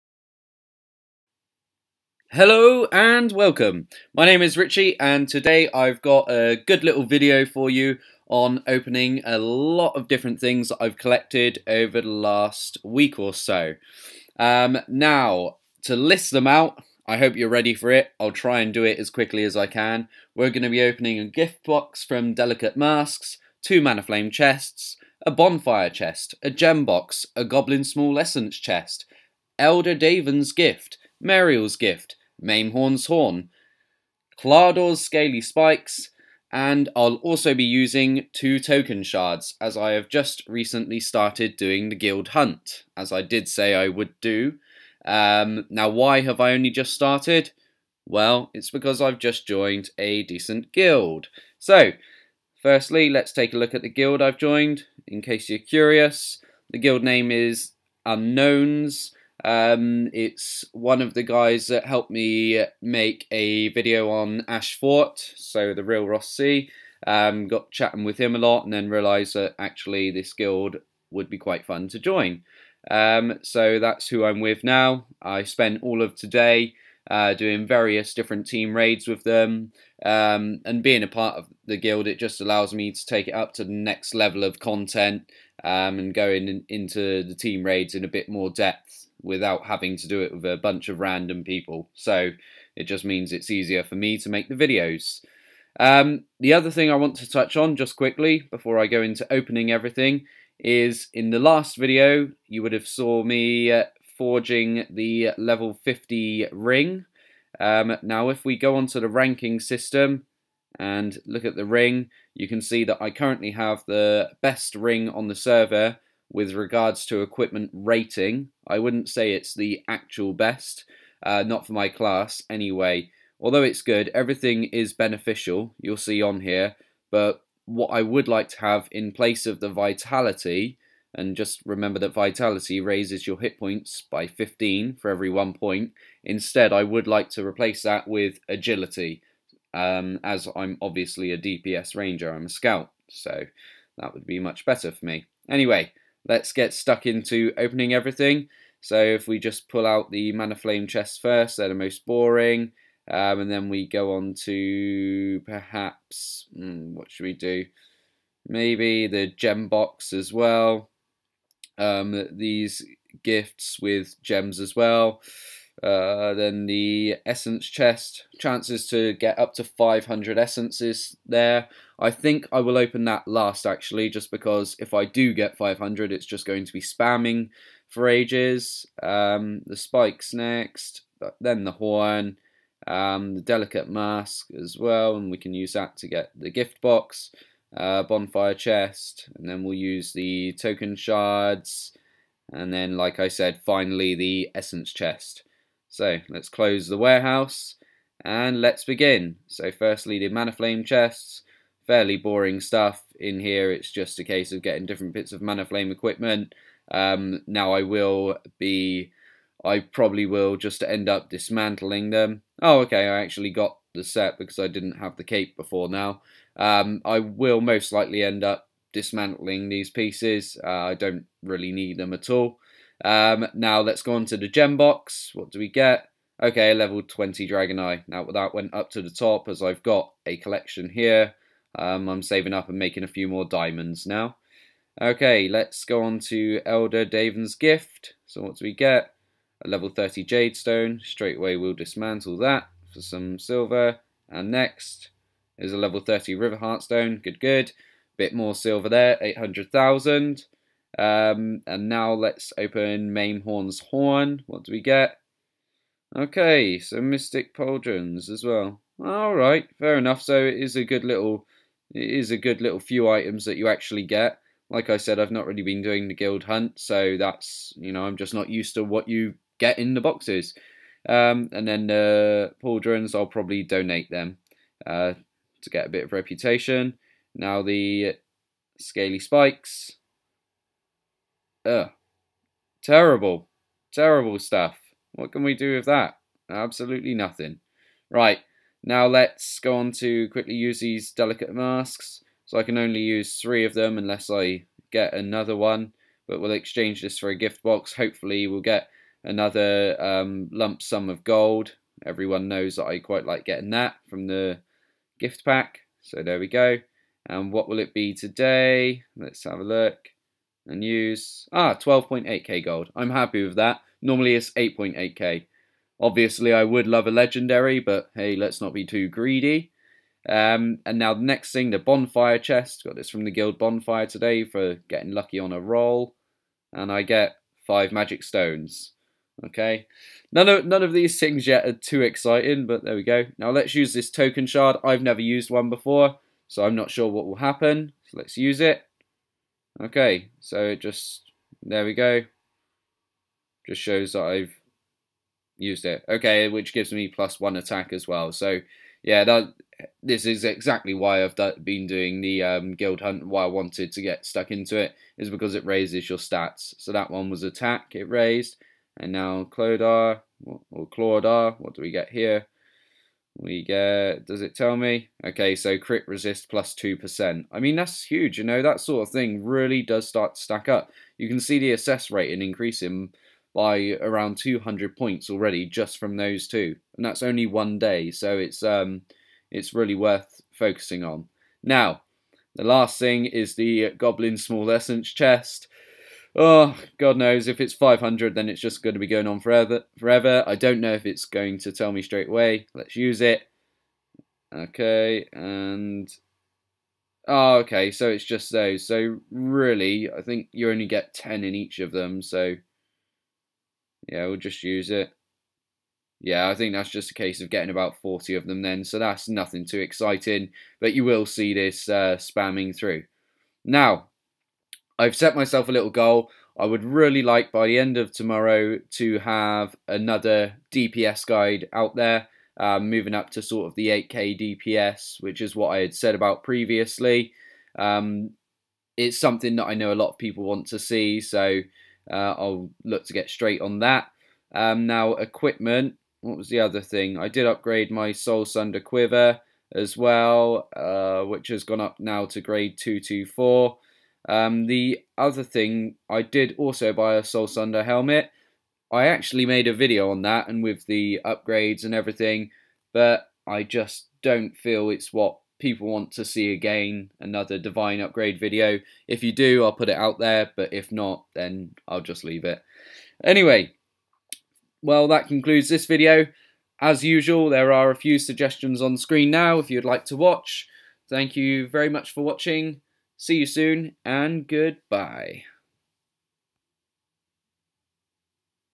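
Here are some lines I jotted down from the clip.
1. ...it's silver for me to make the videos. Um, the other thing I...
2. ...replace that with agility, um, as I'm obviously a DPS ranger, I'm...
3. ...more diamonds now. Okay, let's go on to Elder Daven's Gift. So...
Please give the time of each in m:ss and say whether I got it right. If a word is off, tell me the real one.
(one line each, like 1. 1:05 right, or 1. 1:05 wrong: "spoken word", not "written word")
1. 1:33 wrong: "easier", not "silver"
2. 2:17 right
3. 3:53 right.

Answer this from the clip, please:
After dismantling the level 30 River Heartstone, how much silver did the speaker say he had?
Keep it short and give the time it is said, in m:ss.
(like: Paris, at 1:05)
800,000, at 4:09.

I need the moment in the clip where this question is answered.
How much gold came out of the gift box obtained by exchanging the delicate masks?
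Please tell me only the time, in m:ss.
5:11.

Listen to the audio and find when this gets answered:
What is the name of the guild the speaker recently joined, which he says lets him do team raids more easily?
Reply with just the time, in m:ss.
0:58.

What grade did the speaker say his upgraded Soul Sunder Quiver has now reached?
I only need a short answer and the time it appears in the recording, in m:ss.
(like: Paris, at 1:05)
224, at 7:22.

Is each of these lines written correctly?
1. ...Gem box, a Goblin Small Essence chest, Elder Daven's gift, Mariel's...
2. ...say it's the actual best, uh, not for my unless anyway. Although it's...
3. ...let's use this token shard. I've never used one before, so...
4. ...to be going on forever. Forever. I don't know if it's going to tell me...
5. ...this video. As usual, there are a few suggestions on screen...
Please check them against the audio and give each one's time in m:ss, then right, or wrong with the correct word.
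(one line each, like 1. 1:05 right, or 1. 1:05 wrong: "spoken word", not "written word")
1. 0:26 right
2. 1:59 wrong: "class", not "unless"
3. 5:33 right
4. 6:28 right
5. 7:45 right.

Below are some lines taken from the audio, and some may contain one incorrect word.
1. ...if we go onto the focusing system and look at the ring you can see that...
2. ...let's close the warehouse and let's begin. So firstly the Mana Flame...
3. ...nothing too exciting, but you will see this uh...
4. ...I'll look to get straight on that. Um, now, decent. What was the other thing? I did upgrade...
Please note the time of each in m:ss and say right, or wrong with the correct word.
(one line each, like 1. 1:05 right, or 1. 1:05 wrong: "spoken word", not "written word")
1. 1:48 wrong: "ranking", not "focusing"
2. 3:16 right
3. 6:49 right
4. 7:12 wrong: "equipment", not "decent".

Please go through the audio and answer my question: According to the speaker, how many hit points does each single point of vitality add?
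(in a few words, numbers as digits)
15.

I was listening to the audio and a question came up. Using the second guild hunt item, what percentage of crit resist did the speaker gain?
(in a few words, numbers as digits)
2%.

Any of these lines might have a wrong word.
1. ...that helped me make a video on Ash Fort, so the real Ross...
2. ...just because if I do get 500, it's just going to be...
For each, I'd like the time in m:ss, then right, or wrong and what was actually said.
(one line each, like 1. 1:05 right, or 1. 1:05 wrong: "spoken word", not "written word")
1. 1:01 right
2. 2:54 right.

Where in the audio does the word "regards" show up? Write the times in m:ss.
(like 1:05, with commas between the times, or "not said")
1:56.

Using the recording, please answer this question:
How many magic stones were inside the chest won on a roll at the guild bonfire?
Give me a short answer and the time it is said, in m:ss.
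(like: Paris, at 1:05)
5, at 5:27.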